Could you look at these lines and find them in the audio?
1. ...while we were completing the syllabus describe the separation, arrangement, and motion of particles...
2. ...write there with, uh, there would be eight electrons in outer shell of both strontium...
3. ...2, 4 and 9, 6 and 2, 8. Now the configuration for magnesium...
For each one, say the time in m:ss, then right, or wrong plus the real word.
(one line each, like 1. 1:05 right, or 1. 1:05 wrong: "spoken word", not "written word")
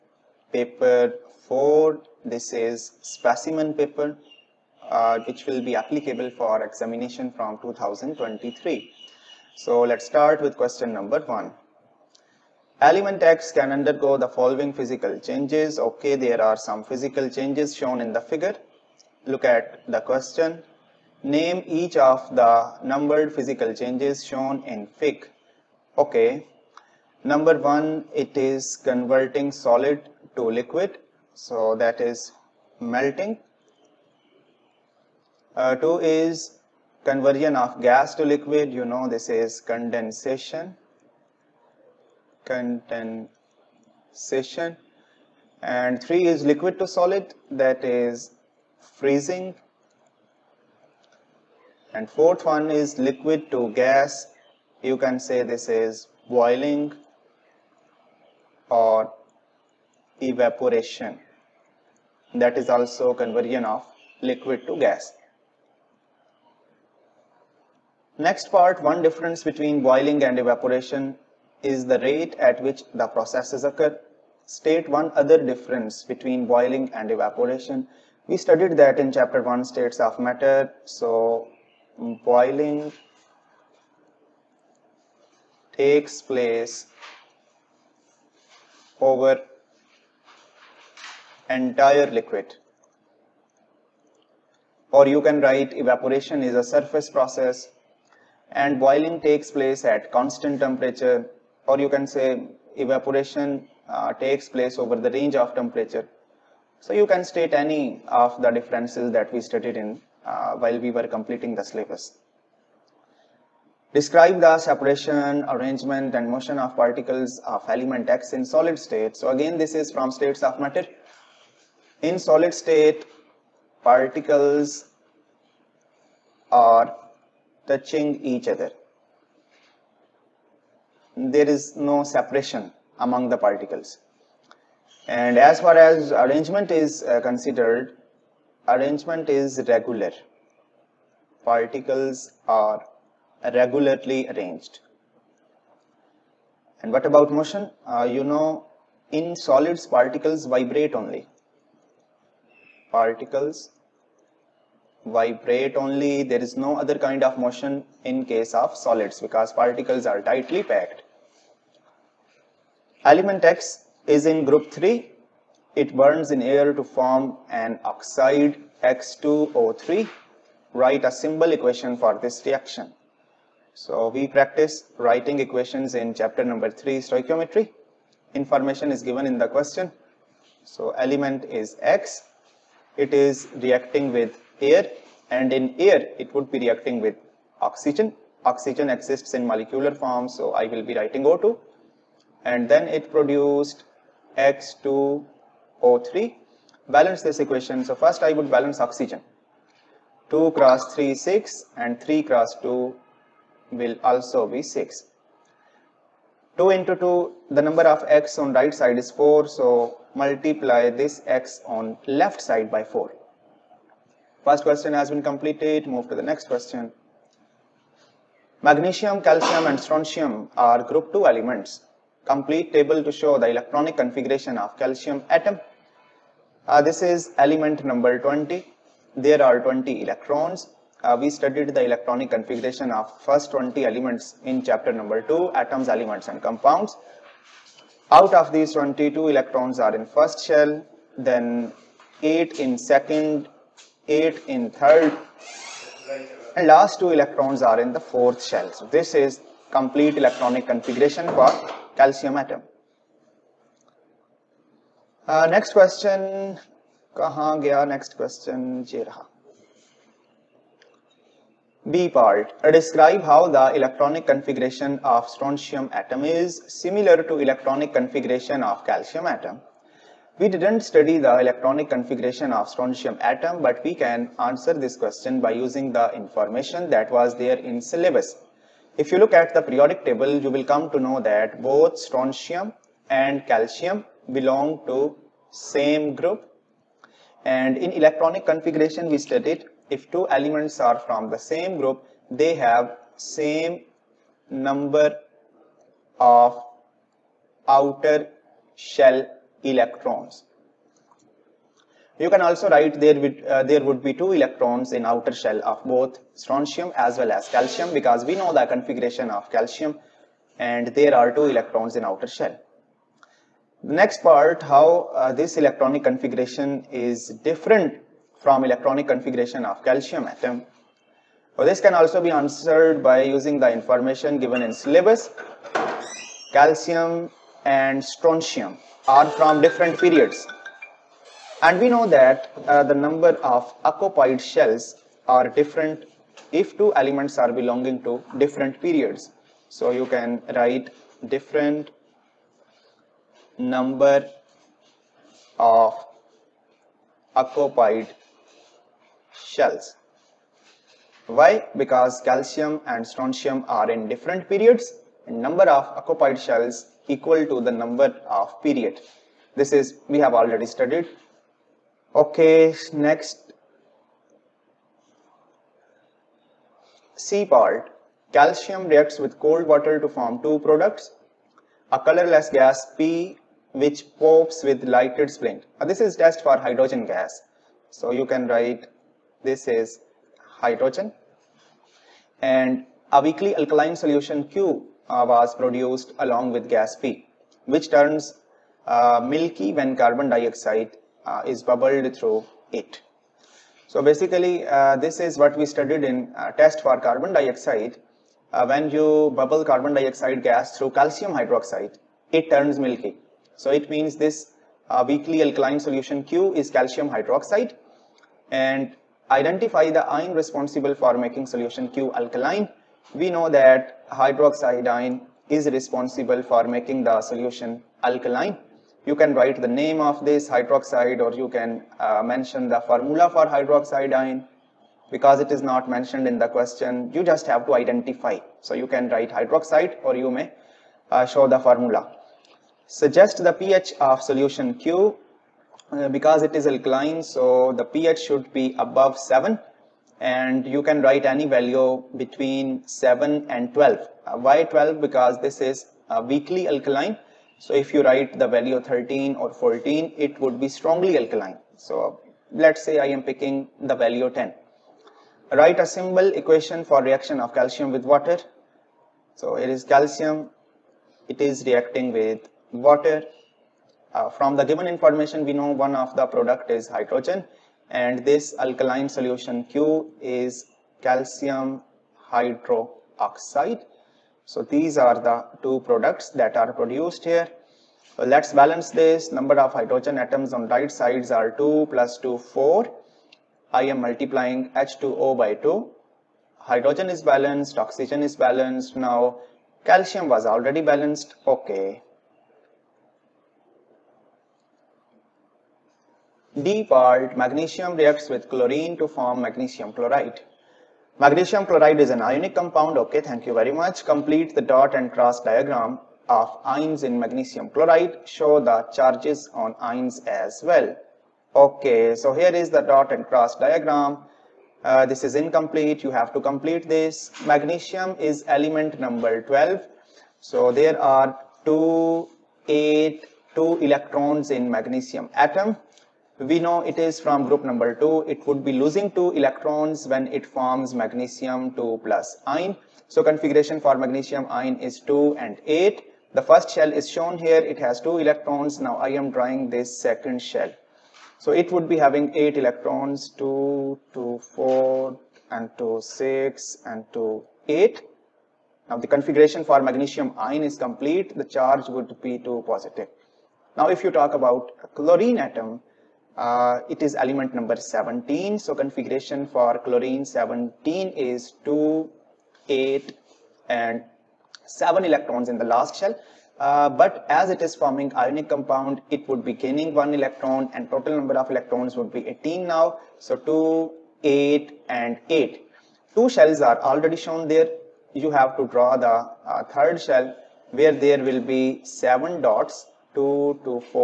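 1. 1:50 right
2. 5:02 wrong: "two", not "eight"
3. 9:04 wrong: "2", not "9".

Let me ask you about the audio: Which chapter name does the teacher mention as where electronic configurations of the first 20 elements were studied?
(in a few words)
atoms elements and compounds.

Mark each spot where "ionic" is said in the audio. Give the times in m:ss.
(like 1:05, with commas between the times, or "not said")
8:22, 9:28.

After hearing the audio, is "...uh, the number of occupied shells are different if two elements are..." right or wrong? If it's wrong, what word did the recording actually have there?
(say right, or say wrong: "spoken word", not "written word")
right.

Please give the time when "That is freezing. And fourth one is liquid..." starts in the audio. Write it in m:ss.
0:47.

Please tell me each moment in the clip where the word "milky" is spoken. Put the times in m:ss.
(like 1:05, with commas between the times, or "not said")
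6:29, 6:42.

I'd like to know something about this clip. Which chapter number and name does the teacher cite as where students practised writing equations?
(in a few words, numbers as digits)
Chapter 3, stoichiometry.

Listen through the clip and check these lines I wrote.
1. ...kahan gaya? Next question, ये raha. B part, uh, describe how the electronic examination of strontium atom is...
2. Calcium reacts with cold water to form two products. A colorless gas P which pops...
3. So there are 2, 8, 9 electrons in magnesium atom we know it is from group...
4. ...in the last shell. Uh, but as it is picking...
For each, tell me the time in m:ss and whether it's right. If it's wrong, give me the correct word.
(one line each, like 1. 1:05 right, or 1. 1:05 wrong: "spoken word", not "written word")
1. 4:17 wrong: "configuration", not "examination"
2. 6:08 right
3. 8:40 wrong: "2", not "9"
4. 9:25 wrong: "forming", not "picking".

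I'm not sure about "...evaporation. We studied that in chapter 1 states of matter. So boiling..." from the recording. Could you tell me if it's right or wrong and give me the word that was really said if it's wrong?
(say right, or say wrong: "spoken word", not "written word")
right.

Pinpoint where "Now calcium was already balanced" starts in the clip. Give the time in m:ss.
8:08.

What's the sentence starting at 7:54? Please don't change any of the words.
So these are the two products that are produced here.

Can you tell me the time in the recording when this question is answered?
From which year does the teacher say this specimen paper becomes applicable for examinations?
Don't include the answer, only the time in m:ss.
0:07.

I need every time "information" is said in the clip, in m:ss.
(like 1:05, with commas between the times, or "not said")
2:58, 4:36, 5:23, 7:44.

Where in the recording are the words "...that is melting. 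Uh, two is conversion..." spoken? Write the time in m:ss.
0:31.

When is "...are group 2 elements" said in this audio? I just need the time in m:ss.
3:40.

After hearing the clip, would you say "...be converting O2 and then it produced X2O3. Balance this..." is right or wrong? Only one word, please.
wrong.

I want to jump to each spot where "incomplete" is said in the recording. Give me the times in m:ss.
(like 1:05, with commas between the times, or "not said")
8:35.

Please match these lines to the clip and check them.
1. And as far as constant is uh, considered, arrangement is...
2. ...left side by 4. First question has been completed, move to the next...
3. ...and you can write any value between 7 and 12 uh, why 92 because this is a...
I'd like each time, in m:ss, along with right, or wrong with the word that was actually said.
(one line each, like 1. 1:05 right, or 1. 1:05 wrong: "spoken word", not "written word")
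1. 2:15 wrong: "arrangement", not "constant"
2. 3:32 right
3. 7:20 wrong: "12", not "92".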